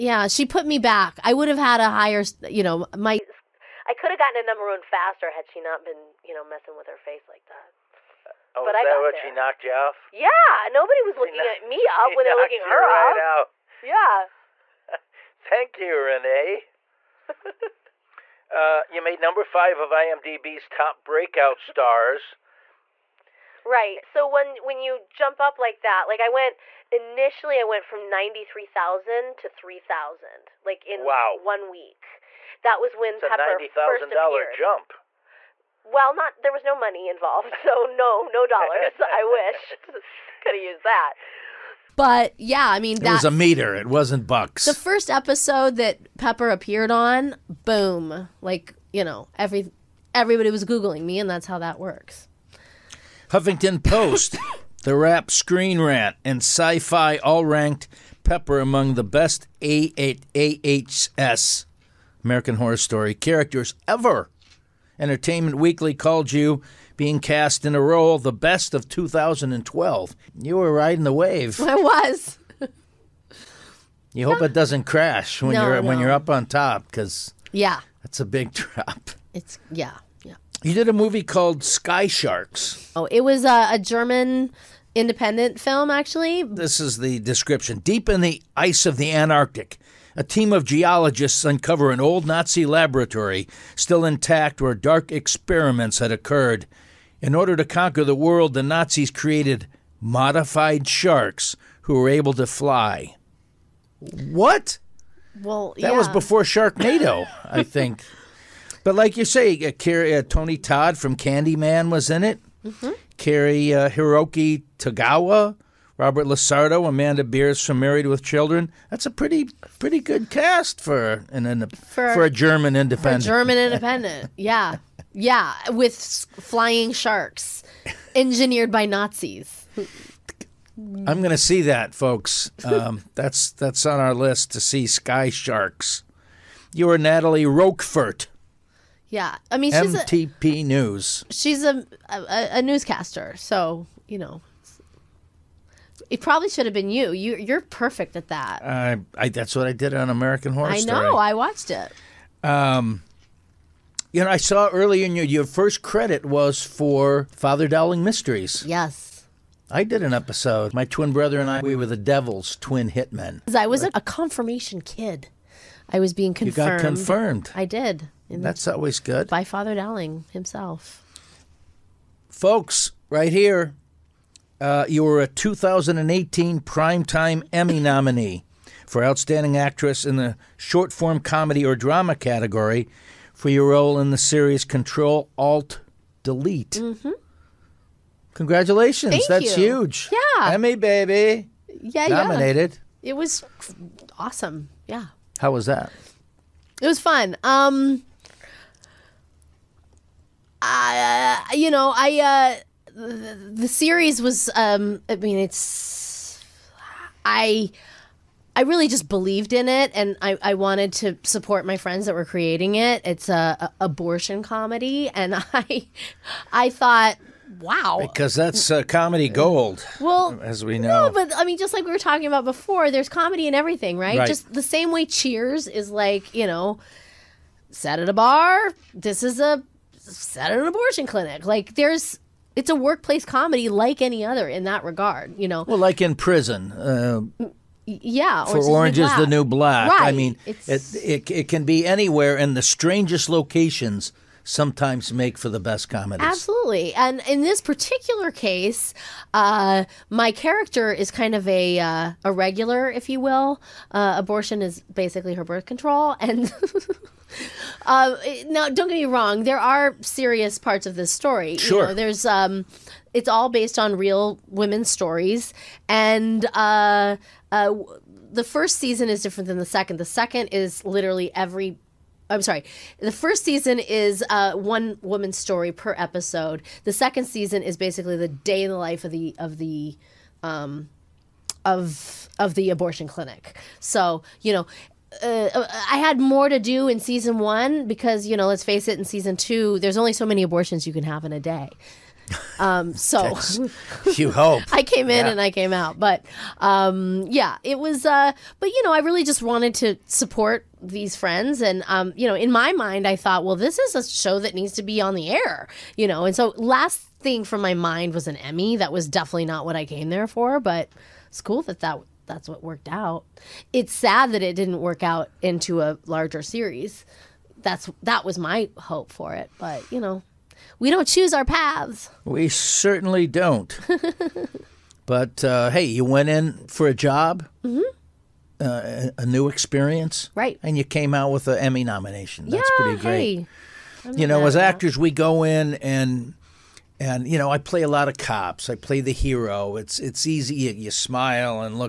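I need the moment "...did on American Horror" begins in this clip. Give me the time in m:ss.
2:29.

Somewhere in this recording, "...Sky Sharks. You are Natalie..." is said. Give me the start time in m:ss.
2:14.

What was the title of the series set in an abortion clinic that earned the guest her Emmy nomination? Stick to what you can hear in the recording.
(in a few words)
Control Alt Delete.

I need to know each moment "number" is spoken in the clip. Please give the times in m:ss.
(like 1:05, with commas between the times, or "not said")
0:04, 0:19.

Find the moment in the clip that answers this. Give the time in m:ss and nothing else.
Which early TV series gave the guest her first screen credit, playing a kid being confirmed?
2:37.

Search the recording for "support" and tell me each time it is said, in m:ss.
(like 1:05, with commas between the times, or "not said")
3:31, 5:00.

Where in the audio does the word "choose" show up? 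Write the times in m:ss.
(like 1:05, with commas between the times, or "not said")
5:21.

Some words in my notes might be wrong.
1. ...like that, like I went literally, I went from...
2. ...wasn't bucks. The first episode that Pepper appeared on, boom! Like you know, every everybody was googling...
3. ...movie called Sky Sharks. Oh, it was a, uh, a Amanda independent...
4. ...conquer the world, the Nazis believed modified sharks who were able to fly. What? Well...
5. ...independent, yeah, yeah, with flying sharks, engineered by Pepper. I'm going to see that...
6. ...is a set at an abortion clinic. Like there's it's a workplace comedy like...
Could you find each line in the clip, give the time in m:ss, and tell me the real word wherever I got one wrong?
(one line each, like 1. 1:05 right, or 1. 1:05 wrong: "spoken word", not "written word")
1. 0:25 wrong: "initially", not "literally"
2. 0:43 right
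3. 1:20 wrong: "German", not "Amanda"
4. 1:37 wrong: "created", not "believed"
5. 2:03 wrong: "Nazis", not "Pepper"
6. 3:49 right.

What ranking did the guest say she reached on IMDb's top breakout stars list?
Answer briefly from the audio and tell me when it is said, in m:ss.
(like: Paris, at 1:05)
5, at 0:19.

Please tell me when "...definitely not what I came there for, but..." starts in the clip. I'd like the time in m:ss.
5:09.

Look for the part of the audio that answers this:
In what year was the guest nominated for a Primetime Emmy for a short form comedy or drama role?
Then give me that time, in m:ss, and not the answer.
2:55.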